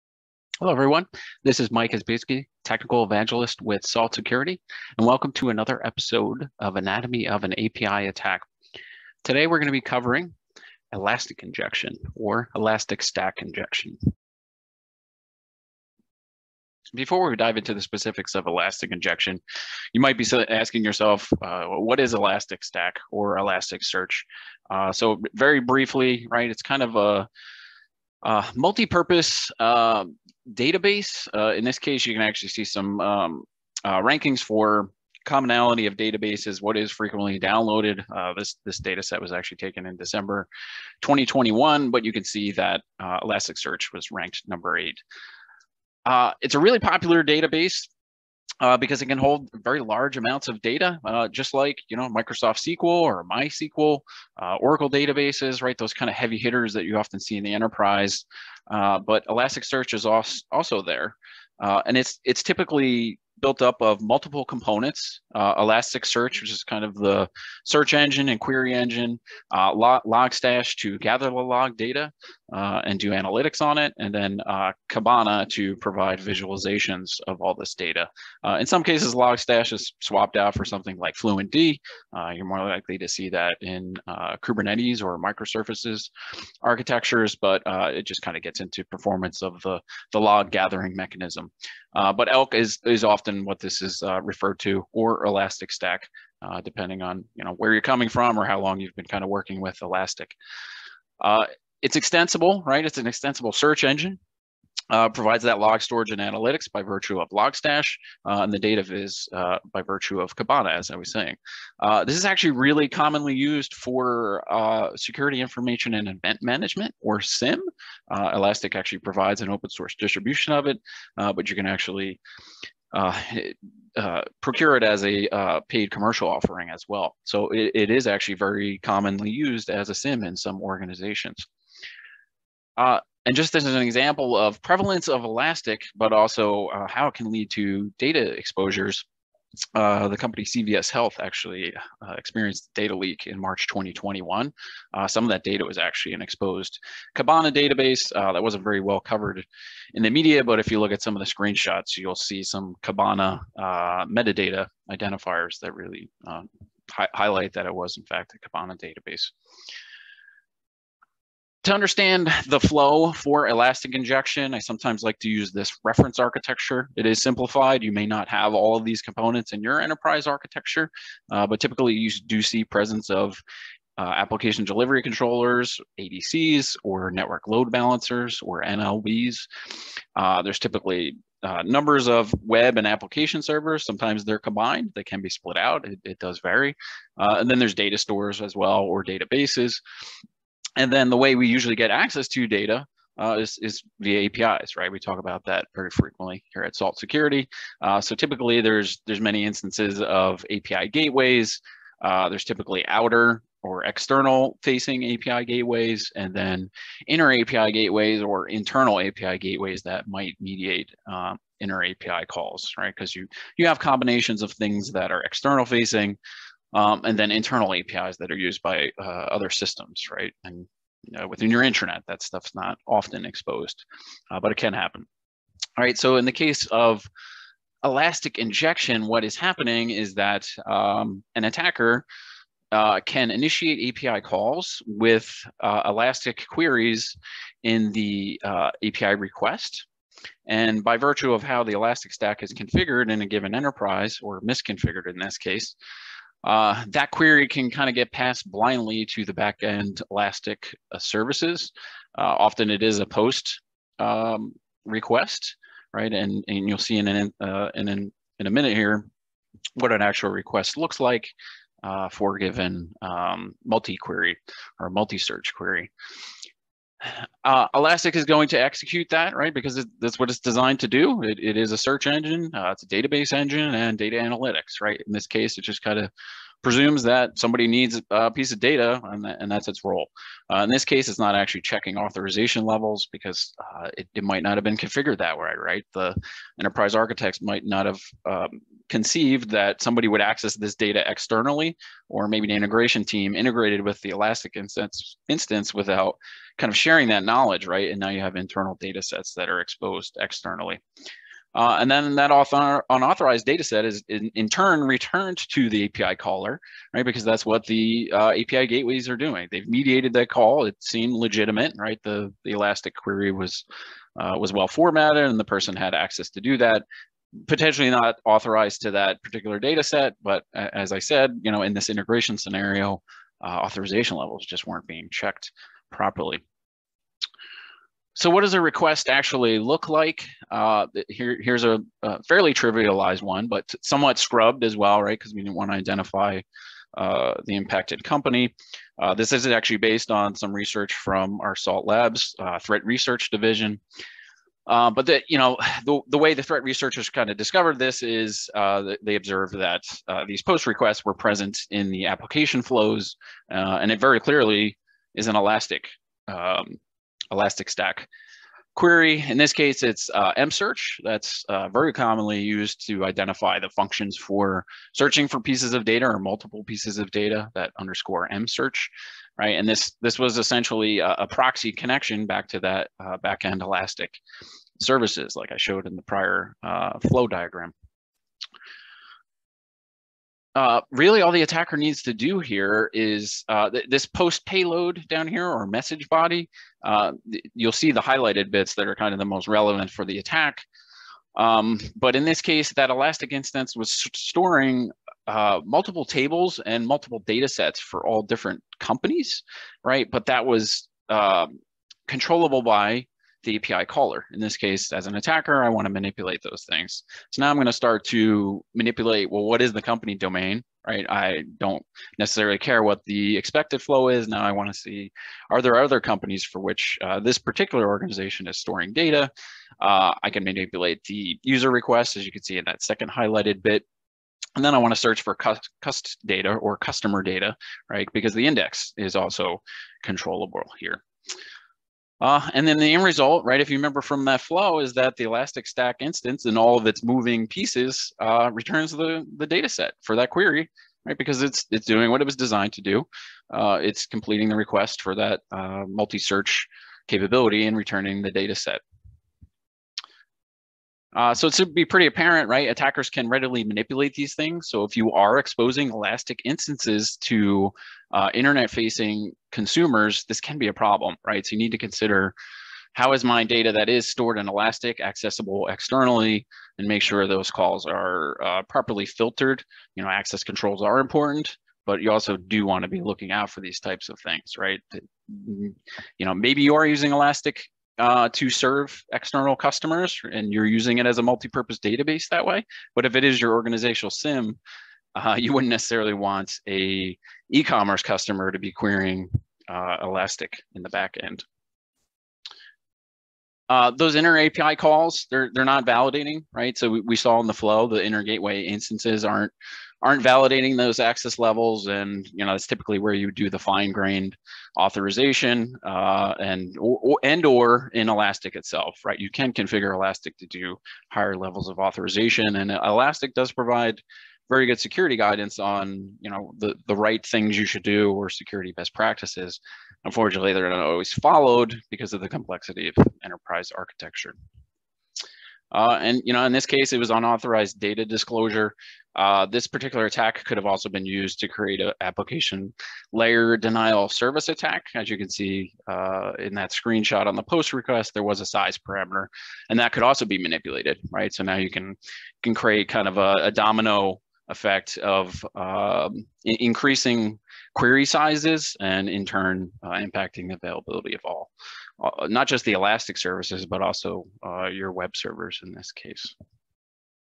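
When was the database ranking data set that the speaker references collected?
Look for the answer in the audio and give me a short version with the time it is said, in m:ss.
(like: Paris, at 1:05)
December 2021, at 0:39.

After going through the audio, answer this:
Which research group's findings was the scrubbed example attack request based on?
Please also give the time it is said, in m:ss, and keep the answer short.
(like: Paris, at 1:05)
SALT Labs, at 5:41.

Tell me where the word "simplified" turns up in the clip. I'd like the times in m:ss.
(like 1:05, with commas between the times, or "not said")
2:47.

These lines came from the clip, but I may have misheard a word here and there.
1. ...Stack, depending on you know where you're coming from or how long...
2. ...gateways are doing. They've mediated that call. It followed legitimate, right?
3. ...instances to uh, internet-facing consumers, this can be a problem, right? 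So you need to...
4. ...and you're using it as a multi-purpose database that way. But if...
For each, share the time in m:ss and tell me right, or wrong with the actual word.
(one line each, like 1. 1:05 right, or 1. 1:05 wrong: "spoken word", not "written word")
1. 1:35 right
2. 5:08 wrong: "seemed", not "followed"
3. 7:36 right
4. 8:00 right.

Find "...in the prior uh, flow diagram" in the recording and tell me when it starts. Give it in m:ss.
6:15.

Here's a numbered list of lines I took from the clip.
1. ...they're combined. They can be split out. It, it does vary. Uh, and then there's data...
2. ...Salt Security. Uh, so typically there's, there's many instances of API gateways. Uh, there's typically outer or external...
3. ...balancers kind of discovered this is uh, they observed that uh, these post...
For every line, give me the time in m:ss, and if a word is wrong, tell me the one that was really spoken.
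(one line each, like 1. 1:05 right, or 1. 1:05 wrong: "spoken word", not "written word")
1. 3:04 right
2. 3:16 right
3. 5:46 wrong: "researchers", not "balancers".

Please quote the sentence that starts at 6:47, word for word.
So now I'm going to start to manipulate, well, what is the company domain, right?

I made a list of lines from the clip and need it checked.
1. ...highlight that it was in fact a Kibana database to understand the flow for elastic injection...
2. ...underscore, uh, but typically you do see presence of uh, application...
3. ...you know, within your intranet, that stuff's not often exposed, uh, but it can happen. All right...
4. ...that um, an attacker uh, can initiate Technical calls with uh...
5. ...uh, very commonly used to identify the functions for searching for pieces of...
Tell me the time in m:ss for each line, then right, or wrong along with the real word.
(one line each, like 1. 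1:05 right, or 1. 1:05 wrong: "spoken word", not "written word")
1. 2:37 right
2. 2:50 wrong: "architecture", not "underscore"
3. 3:41 right
4. 3:50 wrong: "API", not "Technical"
5. 6:01 right.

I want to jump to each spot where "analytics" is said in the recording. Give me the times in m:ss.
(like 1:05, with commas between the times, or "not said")
1:13, 1:46, 4:34.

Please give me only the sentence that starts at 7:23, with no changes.
Uh, it's completing the request for that uh, multi-search capability and returning the data set.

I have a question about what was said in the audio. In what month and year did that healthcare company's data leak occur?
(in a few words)
March 2021.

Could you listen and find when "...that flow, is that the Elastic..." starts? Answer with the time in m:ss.
7:14.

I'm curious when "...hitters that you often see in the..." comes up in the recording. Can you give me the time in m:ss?
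0:56.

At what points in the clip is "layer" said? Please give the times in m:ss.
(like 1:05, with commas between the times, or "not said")
8:53.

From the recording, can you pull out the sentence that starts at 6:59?
Uh, I can manipulate the user request, as you can see in that second highlighted bit.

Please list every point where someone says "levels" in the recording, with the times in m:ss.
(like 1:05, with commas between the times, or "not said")
4:42, 5:24, 8:21, 8:31.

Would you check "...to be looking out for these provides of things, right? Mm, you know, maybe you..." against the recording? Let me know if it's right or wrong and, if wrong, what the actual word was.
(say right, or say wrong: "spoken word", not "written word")
wrong: "types", not "provides".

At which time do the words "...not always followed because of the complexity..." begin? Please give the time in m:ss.
8:40.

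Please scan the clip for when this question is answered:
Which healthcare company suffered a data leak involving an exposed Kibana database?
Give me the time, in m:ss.
2:20.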